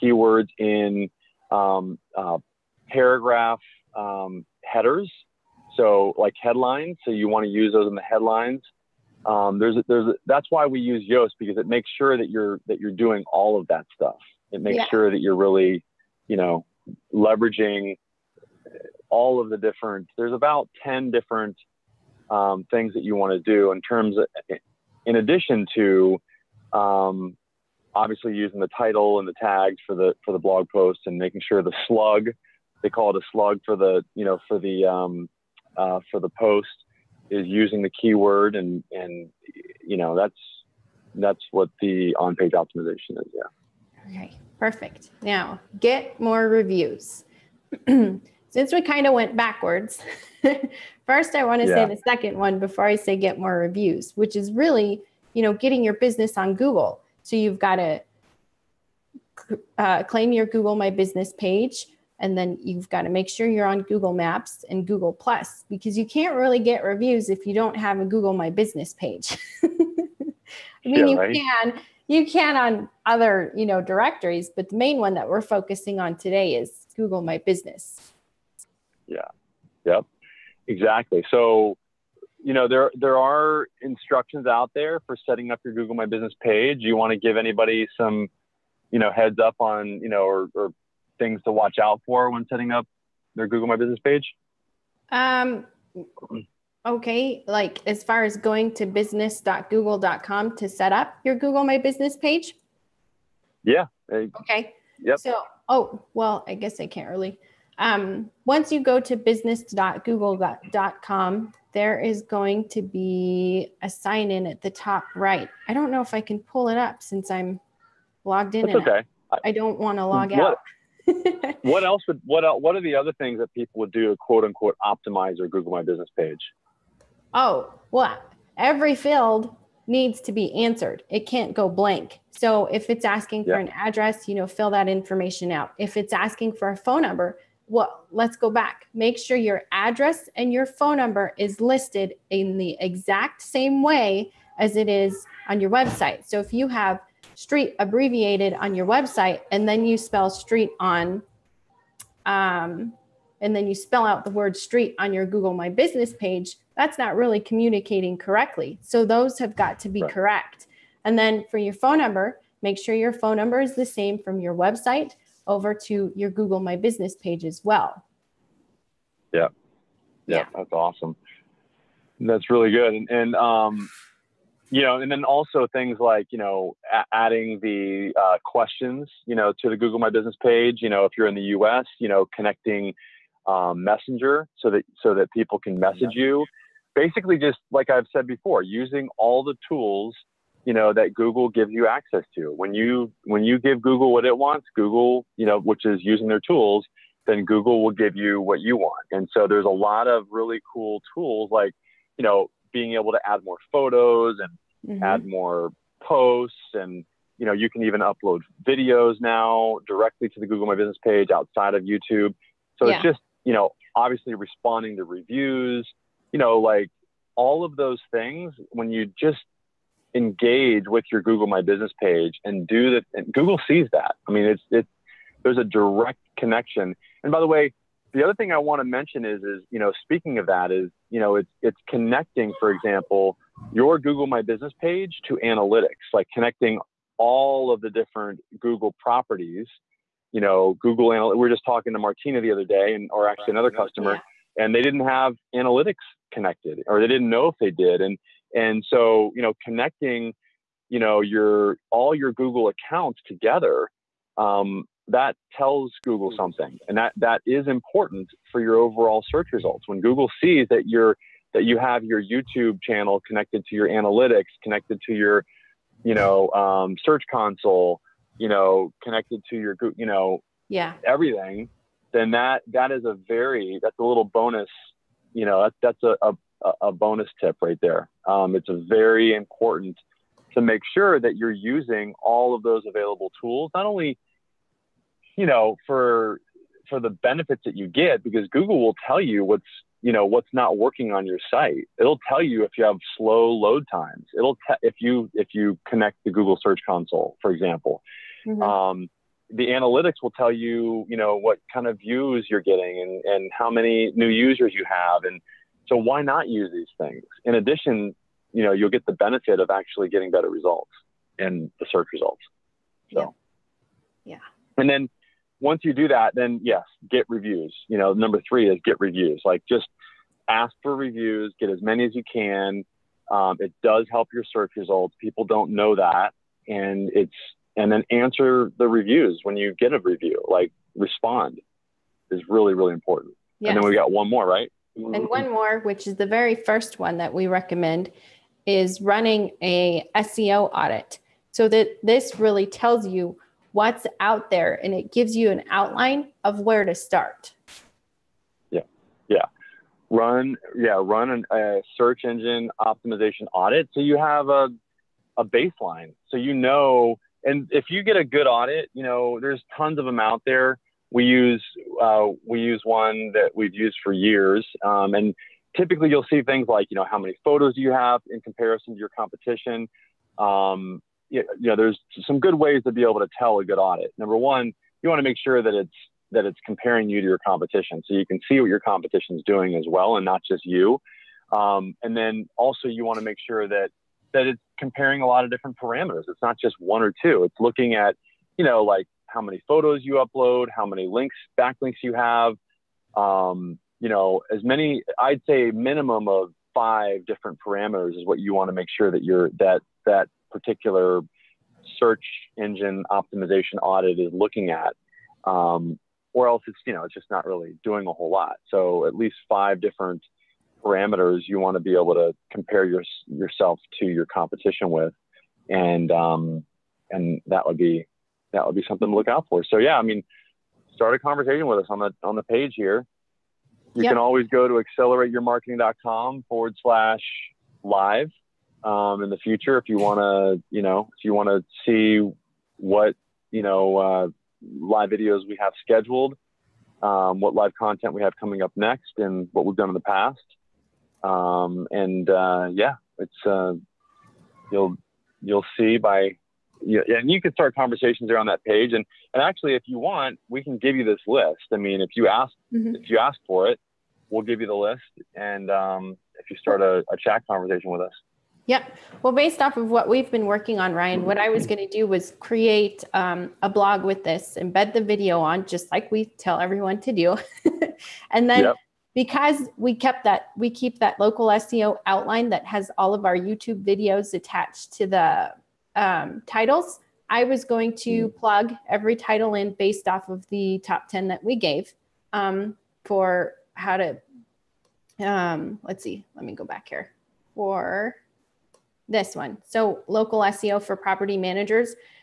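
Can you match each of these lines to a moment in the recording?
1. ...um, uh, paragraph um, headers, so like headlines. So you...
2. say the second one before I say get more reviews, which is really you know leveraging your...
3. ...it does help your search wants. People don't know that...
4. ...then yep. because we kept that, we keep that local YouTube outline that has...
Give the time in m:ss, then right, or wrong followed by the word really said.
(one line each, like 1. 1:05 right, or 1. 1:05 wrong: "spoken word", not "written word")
1. 0:01 right
2. 0:51 wrong: "getting", not "leveraging"
3. 5:23 wrong: "results", not "wants"
4. 7:48 wrong: "SEO", not "YouTube".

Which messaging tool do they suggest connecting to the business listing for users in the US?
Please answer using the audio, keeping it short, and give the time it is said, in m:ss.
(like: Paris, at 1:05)
Messenger, at 3:03.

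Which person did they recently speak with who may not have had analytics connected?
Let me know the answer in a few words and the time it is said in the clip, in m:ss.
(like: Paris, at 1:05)
Martina, at 4:01.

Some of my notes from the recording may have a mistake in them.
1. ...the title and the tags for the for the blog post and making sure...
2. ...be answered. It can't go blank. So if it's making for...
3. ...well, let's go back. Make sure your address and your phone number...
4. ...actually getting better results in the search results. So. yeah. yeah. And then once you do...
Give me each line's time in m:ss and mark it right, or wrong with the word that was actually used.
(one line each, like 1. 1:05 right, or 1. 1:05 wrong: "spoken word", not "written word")
1. 0:28 right
2. 2:10 wrong: "asking", not "making"
3. 2:17 right
4. 5:09 right.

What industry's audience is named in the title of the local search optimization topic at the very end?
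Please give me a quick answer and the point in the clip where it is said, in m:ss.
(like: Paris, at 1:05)
property managers, at 8:10.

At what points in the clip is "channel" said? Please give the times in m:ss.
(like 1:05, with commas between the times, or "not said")
4:22.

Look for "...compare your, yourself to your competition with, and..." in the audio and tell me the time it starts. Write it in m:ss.
6:52.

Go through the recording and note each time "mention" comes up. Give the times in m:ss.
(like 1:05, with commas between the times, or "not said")
3:48.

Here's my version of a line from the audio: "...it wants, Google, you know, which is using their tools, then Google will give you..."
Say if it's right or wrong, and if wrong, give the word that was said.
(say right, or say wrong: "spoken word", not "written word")
right.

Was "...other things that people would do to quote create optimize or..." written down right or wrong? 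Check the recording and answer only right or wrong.
wrong.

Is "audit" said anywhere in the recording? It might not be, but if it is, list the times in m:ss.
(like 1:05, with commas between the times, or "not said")
5:40, 5:53, 5:58, 6:13, 6:43.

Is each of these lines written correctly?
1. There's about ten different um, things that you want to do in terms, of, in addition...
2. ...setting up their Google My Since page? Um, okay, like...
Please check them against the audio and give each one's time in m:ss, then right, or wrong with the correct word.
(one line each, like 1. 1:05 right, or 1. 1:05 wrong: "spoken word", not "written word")
1. 0:20 right
2. 1:32 wrong: "Business", not "Since".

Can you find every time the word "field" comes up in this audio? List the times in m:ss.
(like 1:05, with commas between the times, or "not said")
2:08.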